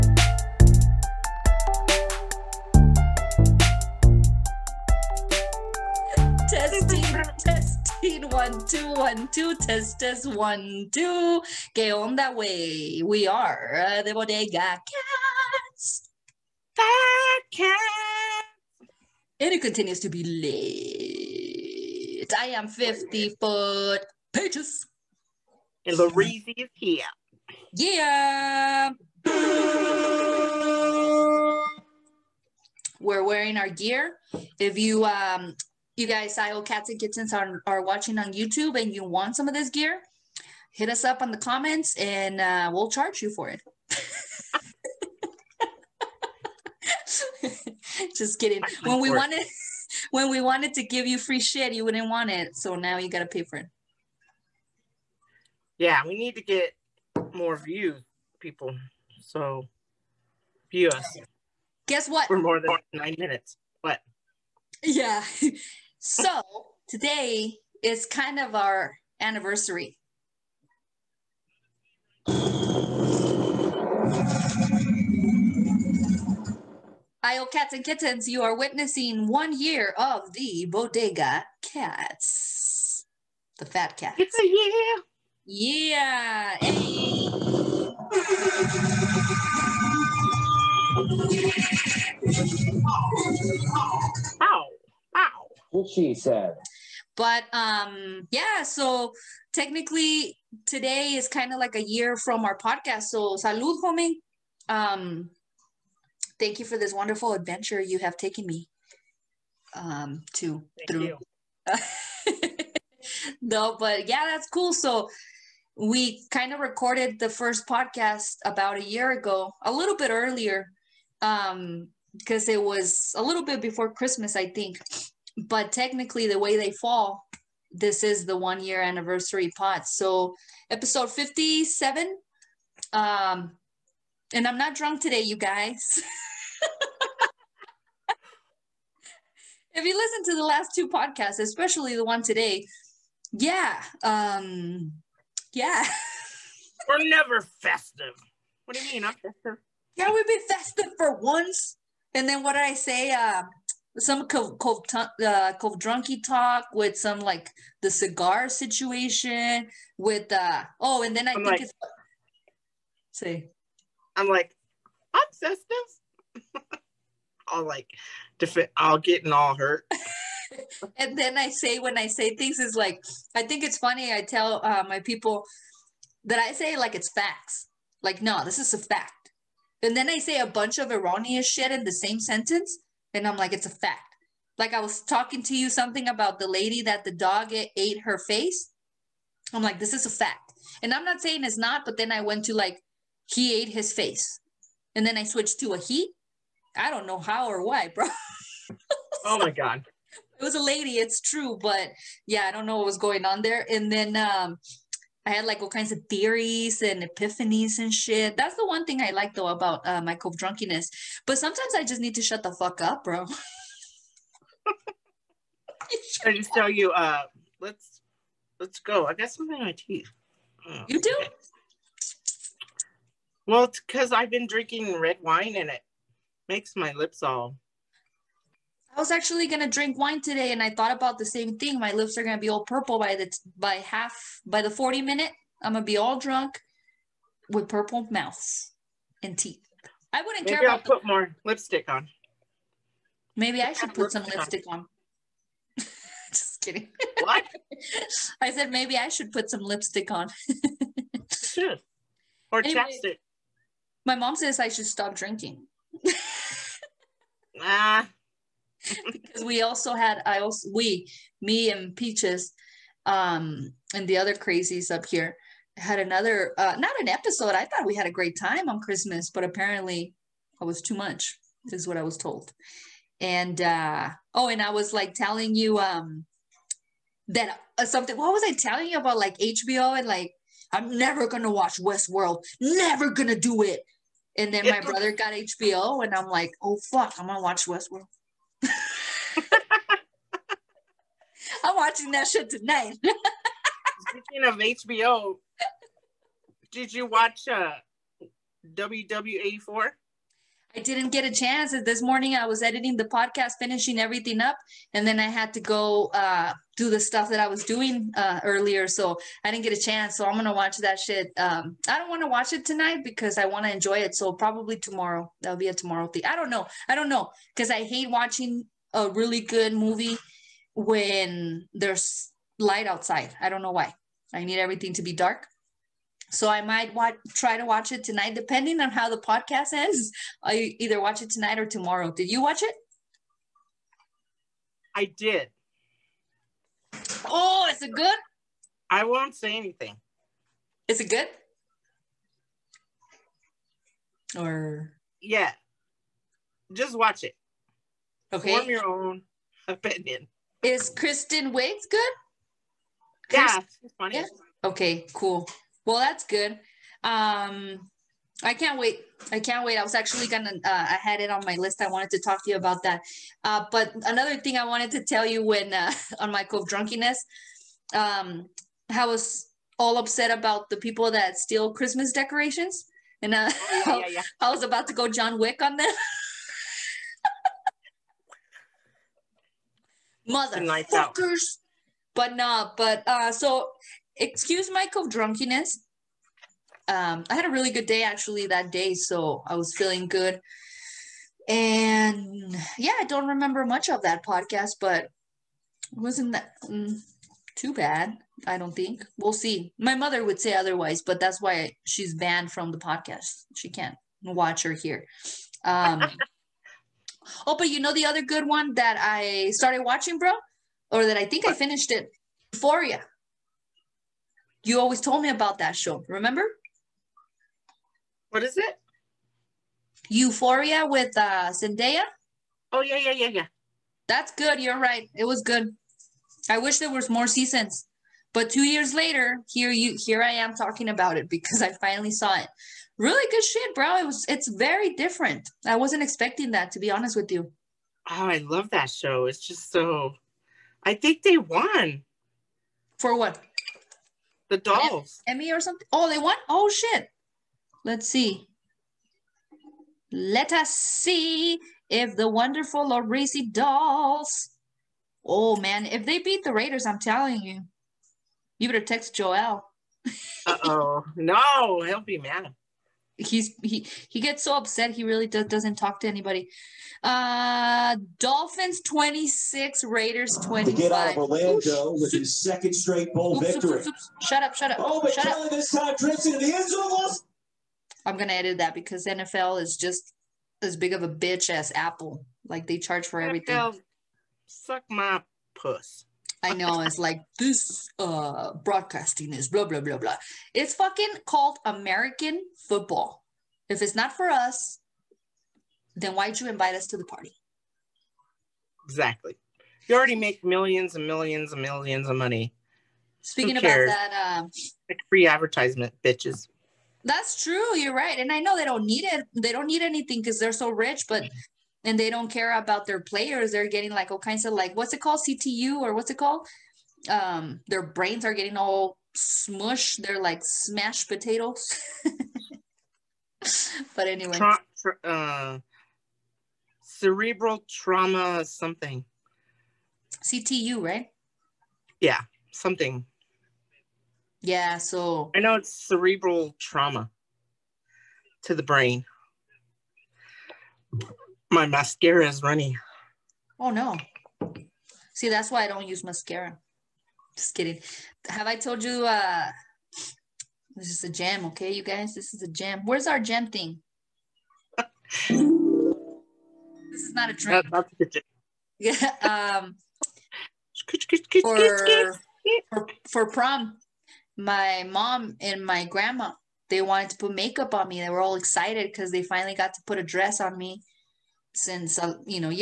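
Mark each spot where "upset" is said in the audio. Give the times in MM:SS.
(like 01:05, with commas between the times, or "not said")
06:09, 07:44.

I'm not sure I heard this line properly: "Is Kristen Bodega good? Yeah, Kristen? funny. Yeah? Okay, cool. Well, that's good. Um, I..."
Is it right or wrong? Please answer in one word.
wrong.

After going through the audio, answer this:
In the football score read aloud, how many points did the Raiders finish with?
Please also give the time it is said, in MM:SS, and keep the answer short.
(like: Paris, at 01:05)
25, at 07:49.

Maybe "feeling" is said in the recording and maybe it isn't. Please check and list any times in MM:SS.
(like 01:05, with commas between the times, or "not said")
06:29.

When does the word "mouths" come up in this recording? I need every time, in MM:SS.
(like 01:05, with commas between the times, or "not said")
03:58.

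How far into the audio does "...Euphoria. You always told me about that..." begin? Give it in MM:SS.
06:52.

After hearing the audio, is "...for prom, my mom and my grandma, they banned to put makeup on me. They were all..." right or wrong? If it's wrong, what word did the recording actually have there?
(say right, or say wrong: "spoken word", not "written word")
wrong: "wanted", not "banned".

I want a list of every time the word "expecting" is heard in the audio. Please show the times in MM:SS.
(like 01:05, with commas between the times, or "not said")
07:16.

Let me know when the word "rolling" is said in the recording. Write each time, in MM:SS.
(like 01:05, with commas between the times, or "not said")
not said.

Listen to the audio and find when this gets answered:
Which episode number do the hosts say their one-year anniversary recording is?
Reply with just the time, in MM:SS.
02:10.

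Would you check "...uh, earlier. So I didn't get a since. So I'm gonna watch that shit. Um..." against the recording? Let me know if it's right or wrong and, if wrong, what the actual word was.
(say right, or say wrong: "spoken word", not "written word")
wrong: "chance", not "since".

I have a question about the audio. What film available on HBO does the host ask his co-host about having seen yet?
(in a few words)
WW84.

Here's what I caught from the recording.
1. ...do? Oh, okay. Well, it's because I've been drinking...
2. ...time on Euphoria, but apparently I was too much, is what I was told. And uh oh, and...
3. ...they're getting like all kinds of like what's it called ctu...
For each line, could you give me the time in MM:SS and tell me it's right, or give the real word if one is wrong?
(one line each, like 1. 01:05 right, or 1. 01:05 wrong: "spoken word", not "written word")
1. 03:41 right
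2. 04:28 wrong: "Christmas", not "Euphoria"
3. 08:33 right.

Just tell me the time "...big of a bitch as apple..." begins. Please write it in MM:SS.
08:00.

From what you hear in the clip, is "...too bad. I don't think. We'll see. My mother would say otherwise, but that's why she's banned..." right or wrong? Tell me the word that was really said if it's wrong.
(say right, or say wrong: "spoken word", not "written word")
right.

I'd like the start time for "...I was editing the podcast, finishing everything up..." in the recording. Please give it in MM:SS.
05:02.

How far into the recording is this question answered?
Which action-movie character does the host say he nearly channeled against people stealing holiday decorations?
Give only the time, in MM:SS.
06:15.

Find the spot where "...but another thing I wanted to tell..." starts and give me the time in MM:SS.
06:03.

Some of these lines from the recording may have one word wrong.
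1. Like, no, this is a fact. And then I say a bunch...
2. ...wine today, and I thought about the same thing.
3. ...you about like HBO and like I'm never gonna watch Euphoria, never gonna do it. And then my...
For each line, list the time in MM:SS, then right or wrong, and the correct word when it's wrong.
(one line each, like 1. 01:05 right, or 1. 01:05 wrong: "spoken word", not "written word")
1. 02:58 right
2. 03:49 right
3. 04:38 wrong: "Westworld", not "Euphoria".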